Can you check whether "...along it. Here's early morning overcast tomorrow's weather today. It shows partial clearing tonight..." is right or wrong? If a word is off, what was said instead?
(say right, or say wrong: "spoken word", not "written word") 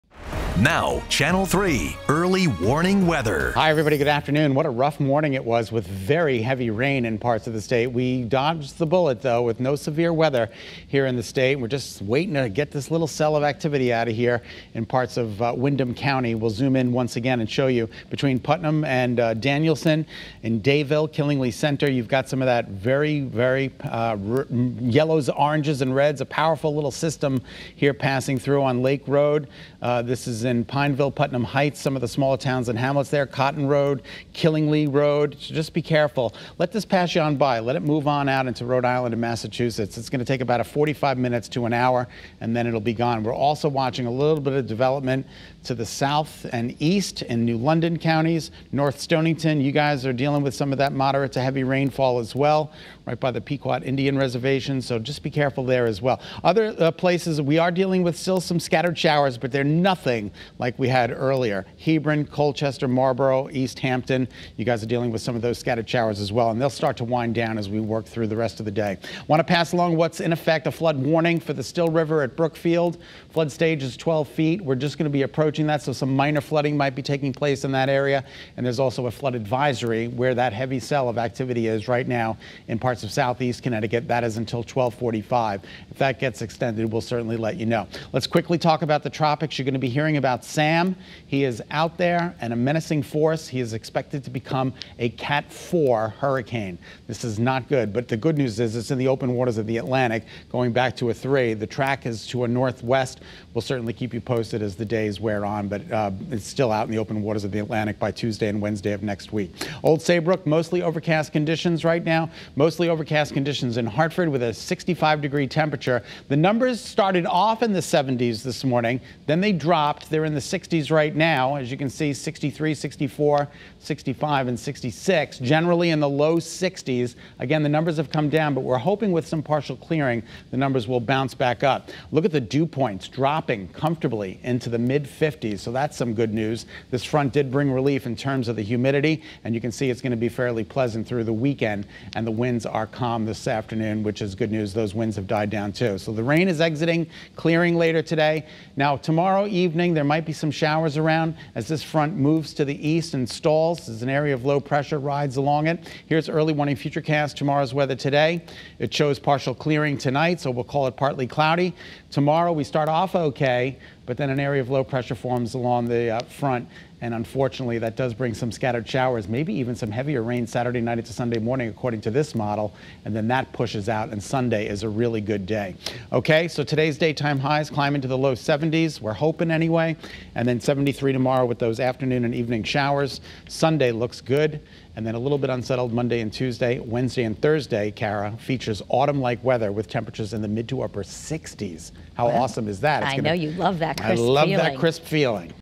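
wrong: "futurecast", not "overcast".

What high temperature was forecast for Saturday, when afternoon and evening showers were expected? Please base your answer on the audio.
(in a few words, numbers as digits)
73.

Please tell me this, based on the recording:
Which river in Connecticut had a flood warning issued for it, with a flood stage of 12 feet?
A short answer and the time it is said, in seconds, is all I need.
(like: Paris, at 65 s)
Still River, at 71 s.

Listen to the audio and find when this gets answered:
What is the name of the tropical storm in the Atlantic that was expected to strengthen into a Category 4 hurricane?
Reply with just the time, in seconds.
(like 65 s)
90 s.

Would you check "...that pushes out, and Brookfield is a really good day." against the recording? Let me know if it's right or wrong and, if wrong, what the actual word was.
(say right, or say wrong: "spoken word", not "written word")
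wrong: "Sunday", not "Brookfield".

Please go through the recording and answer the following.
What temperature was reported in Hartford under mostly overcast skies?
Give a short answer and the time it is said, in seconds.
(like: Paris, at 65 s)
65 degrees, at 114 s.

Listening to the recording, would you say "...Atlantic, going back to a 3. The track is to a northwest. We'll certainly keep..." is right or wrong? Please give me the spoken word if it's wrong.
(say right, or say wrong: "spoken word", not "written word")
right.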